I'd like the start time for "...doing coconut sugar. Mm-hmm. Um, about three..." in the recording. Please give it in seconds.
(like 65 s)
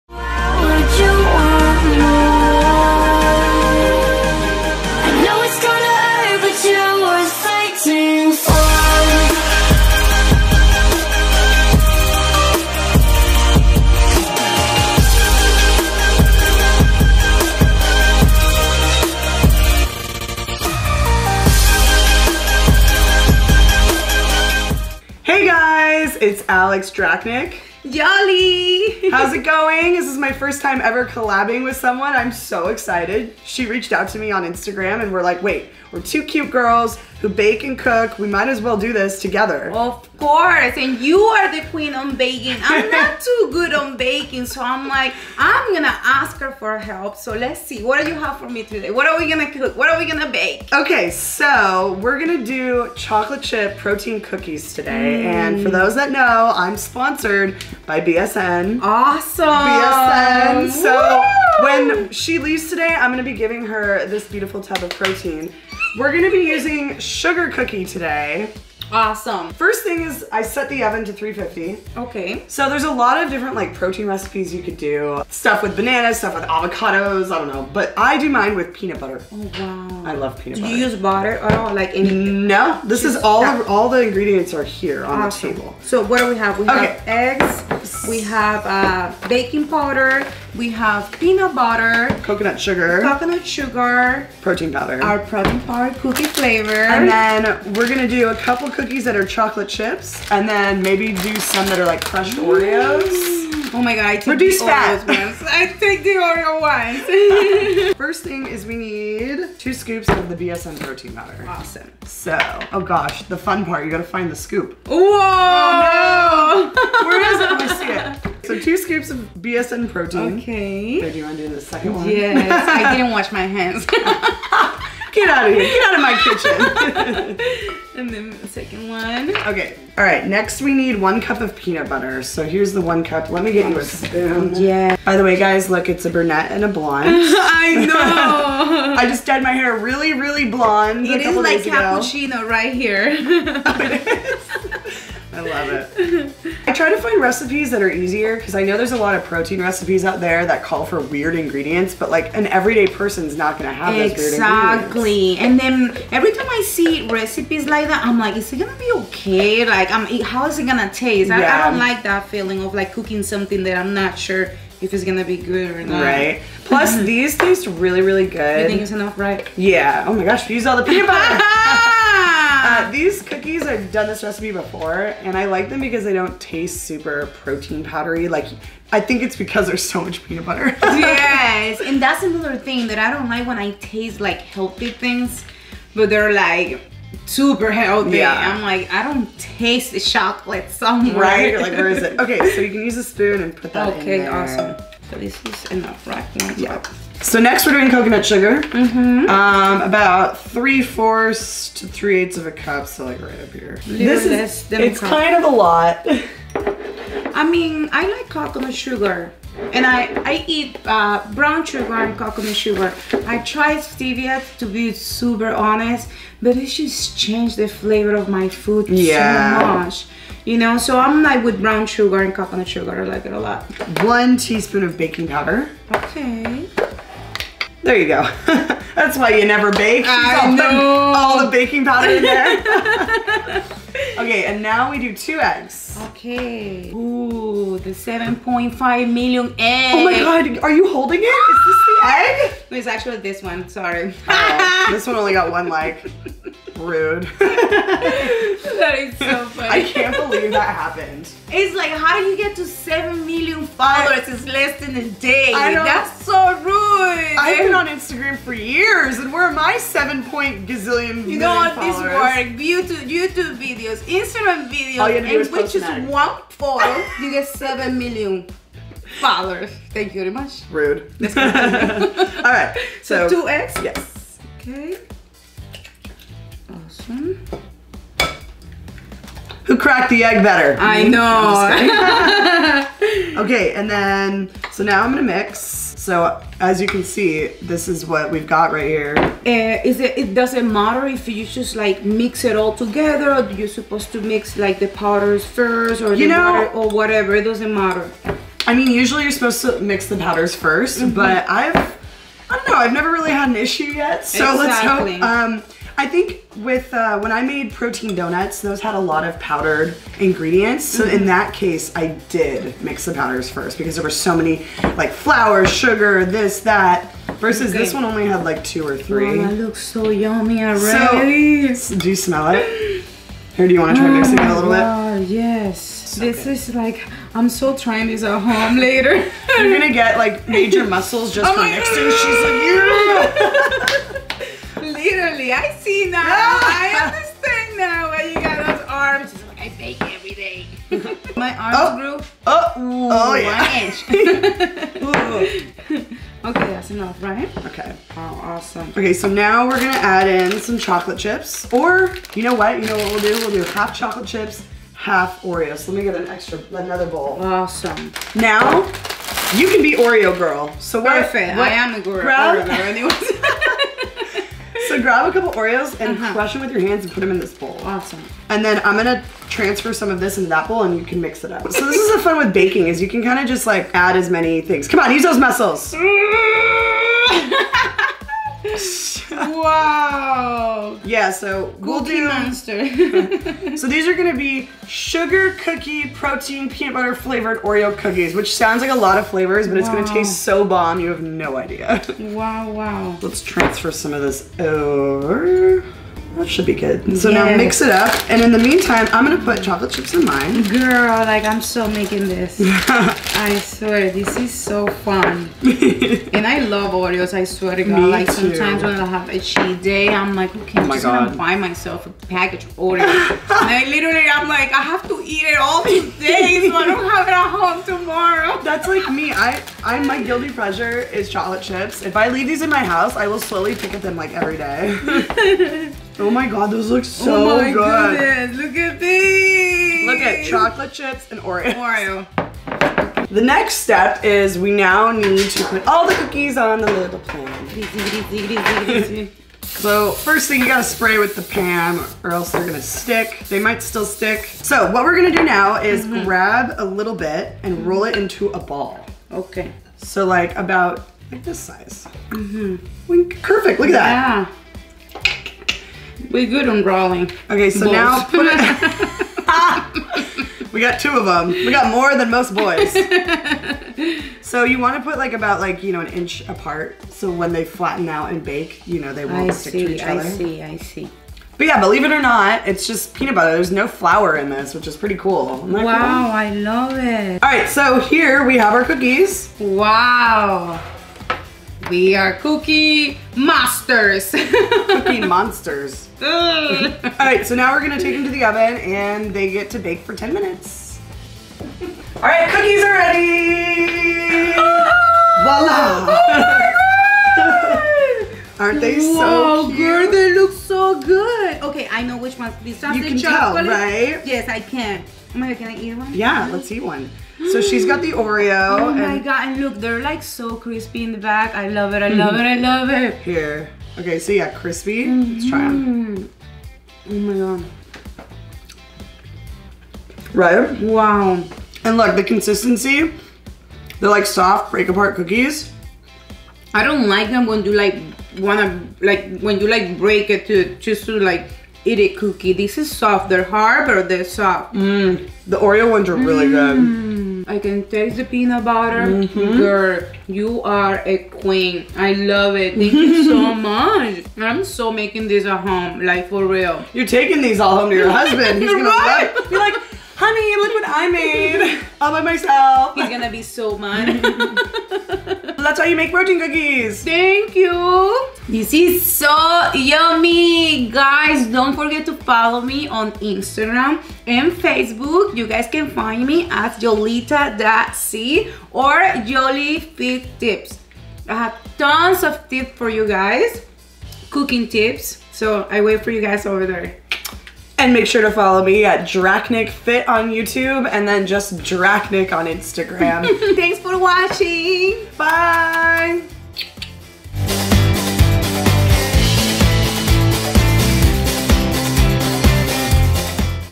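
197 s.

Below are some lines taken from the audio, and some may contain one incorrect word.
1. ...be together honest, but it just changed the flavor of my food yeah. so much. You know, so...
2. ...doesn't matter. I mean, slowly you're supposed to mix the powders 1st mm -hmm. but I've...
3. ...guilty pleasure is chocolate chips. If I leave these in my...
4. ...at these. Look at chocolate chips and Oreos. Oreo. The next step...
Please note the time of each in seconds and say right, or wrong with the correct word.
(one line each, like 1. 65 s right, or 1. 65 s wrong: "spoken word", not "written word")
1. 214 s wrong: "super", not "together"
2. 297 s wrong: "usually", not "slowly"
3. 420 s right
4. 428 s right.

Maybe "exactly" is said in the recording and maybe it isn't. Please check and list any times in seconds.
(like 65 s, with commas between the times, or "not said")
153 s, 304 s.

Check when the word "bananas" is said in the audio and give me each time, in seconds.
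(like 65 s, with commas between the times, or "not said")
75 s.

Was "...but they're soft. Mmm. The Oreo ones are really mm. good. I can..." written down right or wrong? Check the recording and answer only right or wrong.
right.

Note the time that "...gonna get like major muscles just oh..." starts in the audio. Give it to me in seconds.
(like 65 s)
329 s.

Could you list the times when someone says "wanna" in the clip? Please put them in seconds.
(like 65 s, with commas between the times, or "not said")
528 s.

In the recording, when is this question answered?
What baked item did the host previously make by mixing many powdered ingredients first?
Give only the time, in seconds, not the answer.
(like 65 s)
307 s.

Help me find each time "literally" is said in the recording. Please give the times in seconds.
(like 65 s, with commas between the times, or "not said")
334 s, 413 s.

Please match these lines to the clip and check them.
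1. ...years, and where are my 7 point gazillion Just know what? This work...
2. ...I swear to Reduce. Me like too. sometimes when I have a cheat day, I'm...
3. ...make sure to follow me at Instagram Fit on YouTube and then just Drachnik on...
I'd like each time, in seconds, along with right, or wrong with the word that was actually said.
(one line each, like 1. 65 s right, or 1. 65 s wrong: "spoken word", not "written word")
1. 258 s wrong: "You", not "Just"
2. 407 s wrong: "God", not "Reduce"
3. 577 s wrong: "Drachnik", not "Instagram".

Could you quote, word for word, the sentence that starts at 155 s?
And then every time I see recipes like that, I'm like, is it gonna be okay?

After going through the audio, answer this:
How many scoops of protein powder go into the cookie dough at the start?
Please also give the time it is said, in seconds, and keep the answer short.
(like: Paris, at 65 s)
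2, at 108 s.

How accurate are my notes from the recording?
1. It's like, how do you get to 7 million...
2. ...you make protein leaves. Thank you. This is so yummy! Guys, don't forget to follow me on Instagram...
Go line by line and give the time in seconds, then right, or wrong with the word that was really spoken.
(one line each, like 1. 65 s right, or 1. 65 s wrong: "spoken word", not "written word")
1. 251 s right
2. 555 s wrong: "cookies", not "leaves".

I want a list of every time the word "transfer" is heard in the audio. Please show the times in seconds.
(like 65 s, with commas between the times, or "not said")
369 s, 393 s.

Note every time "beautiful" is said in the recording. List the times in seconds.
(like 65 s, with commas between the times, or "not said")
64 s.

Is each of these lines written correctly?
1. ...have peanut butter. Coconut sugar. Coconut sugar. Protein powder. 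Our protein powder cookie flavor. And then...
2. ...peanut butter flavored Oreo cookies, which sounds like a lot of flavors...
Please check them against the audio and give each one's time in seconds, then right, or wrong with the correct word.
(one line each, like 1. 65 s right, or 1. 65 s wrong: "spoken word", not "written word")
1. 90 s right
2. 386 s right.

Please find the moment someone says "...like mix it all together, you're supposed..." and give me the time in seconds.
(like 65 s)
291 s.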